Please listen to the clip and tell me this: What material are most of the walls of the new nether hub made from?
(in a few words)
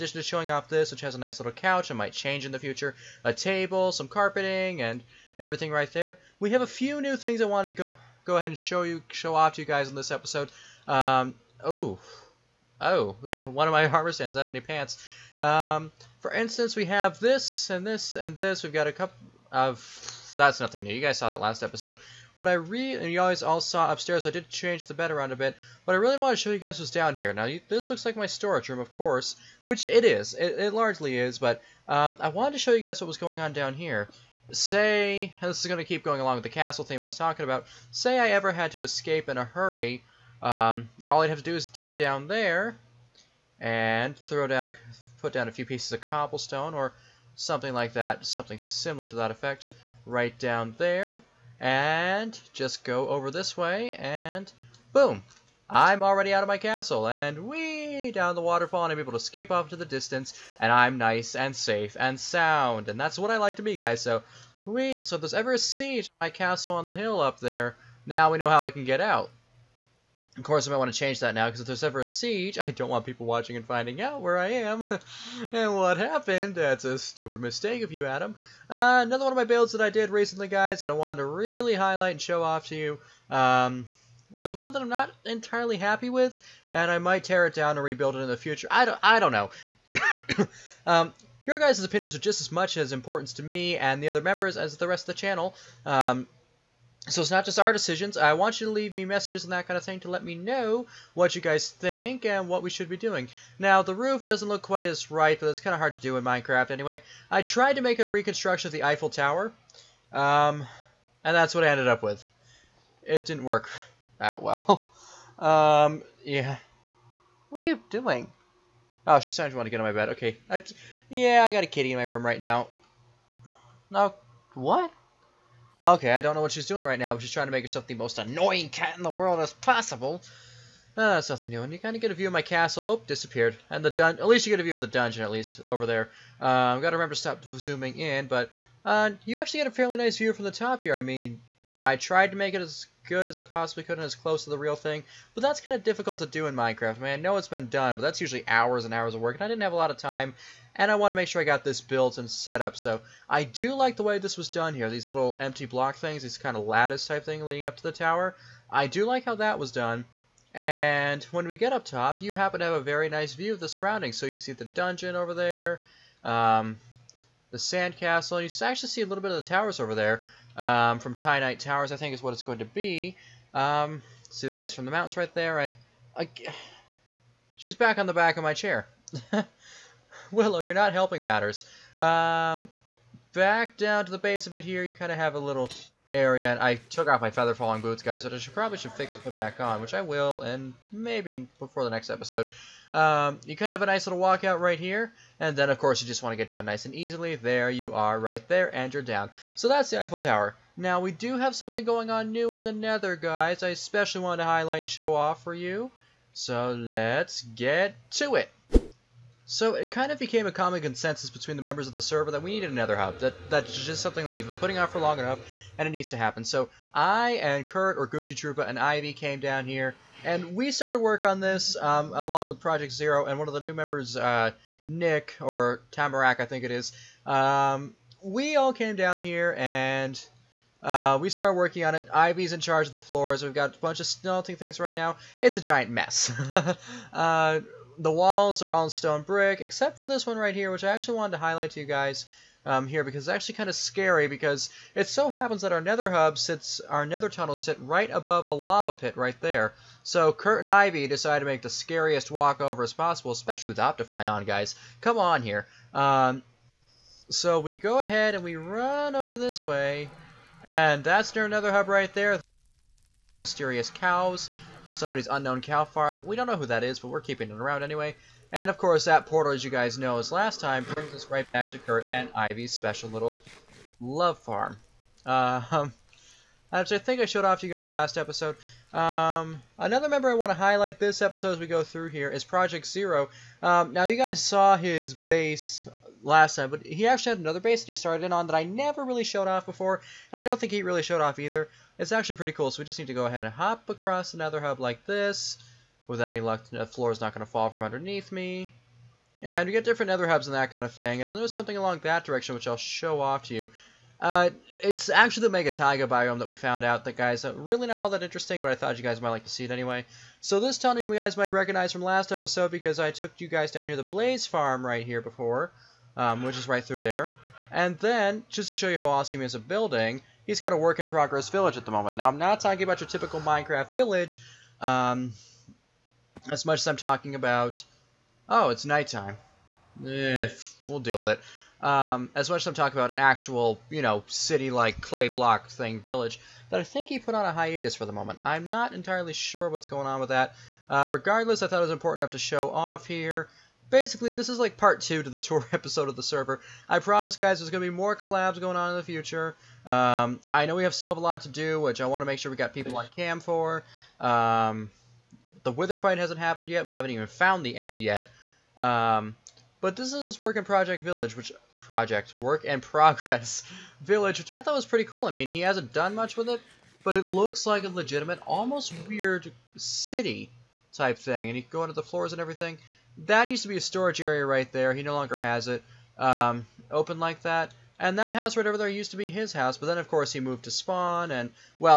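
stone brick.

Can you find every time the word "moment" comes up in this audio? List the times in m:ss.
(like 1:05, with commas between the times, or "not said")
5:21, 5:38.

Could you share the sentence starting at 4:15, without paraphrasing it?
Um, so we go ahead and we run over this way, and that's near another hub right there.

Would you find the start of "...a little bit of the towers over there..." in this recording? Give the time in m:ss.
2:49.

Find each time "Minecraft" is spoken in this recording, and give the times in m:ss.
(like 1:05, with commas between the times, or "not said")
1:46, 2:26, 5:23.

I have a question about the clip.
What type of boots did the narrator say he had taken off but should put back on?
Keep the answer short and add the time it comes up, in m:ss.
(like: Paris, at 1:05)
feather falling boots, at 3:07.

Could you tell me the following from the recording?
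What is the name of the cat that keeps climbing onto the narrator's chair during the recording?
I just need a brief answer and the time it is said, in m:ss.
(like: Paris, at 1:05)
Willow, at 3:00.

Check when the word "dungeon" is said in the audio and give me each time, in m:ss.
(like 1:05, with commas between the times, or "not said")
2:14, 2:44.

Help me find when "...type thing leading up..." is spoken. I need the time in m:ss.
2:37.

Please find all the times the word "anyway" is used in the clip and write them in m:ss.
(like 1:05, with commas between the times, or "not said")
1:46, 4:27, 5:09.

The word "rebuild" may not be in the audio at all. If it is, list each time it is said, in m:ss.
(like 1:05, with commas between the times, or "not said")
1:27.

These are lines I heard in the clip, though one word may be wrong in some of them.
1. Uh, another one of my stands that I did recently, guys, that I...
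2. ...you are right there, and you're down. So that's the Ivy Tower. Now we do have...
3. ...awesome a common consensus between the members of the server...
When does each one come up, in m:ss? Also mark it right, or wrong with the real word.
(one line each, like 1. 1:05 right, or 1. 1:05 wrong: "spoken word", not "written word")
1. 1:18 wrong: "builds", not "stands"
2. 3:17 wrong: "Eiffel", not "Ivy"
3. 3:30 wrong: "became", not "awesome".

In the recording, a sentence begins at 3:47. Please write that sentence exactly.
Um, we all came down here and uh, we started working on it.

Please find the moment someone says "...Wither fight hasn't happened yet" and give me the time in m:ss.
5:55.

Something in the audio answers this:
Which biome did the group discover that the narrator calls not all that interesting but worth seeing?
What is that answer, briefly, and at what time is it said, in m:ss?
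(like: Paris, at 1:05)
Mega Taiga, at 5:05.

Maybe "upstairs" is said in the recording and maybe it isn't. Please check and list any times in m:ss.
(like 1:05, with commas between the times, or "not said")
0:23.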